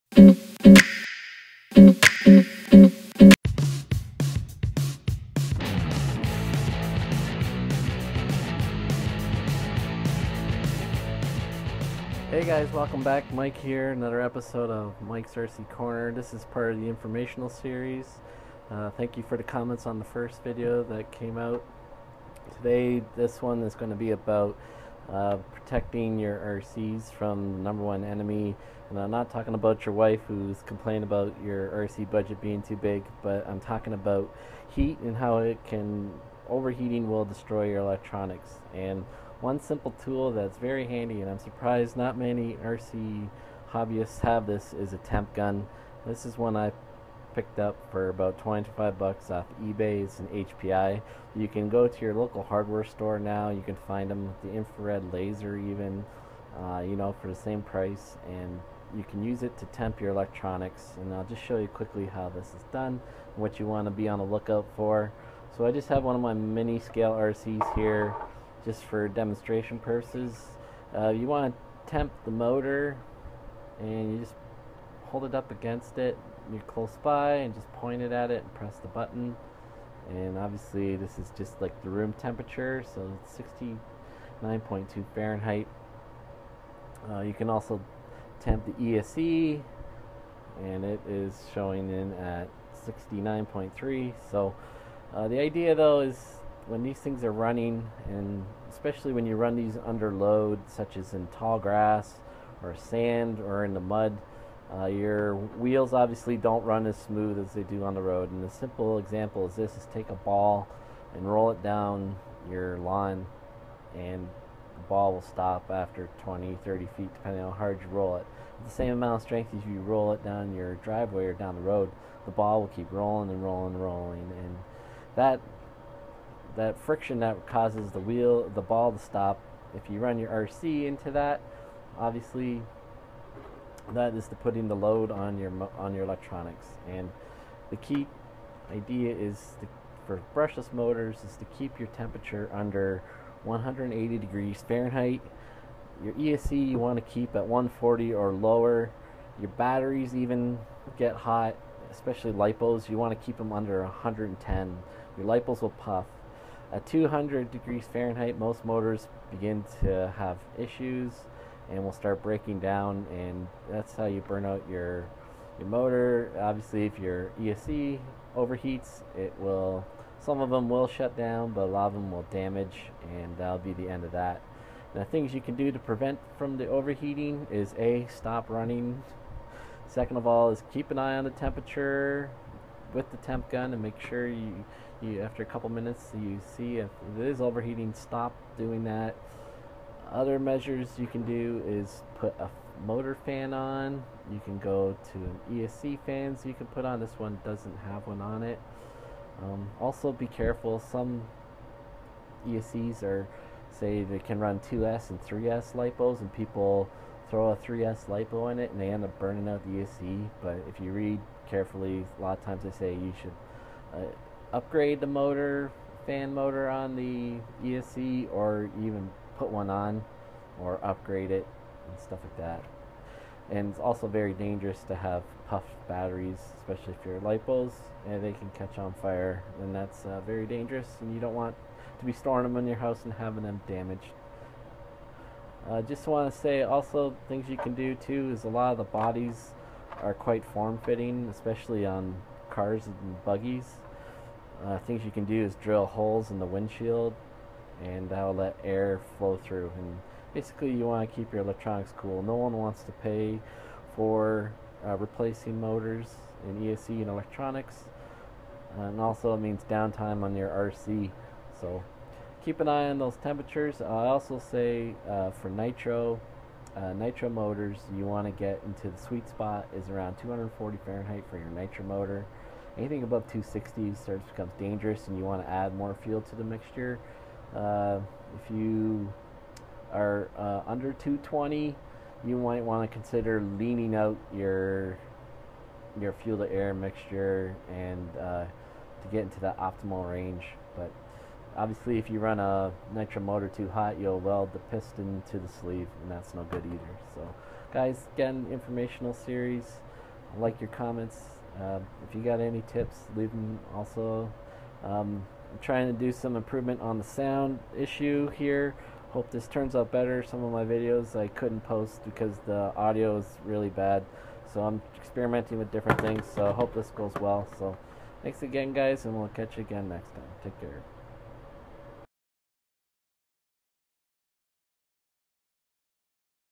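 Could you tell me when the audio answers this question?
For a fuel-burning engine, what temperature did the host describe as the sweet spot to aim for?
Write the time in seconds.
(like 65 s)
270 s.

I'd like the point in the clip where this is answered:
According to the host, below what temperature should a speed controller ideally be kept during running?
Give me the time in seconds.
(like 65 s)
147 s.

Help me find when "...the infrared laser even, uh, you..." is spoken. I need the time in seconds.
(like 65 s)
54 s.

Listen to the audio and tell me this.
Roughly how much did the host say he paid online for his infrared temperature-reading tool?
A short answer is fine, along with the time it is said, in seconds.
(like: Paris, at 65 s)
25 bucks, at 48 s.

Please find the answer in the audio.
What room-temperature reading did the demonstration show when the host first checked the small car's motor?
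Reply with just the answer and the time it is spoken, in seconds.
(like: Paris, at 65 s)
69.2 Fahrenheit, at 84 s.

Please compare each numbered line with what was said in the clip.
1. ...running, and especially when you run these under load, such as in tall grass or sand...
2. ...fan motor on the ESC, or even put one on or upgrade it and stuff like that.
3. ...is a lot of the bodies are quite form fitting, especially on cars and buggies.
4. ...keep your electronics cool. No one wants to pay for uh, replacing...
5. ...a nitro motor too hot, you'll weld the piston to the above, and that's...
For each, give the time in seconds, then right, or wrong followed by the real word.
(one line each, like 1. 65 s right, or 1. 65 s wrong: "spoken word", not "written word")
1. 97 s right
2. 216 s right
3. 238 s right
4. 251 s right
5. 292 s wrong: "sleeve", not "above".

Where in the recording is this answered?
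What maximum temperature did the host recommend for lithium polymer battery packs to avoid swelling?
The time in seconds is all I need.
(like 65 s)
153 s.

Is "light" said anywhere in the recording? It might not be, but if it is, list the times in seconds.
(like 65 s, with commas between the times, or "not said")
227 s.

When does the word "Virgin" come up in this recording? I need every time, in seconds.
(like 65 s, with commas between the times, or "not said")
not said.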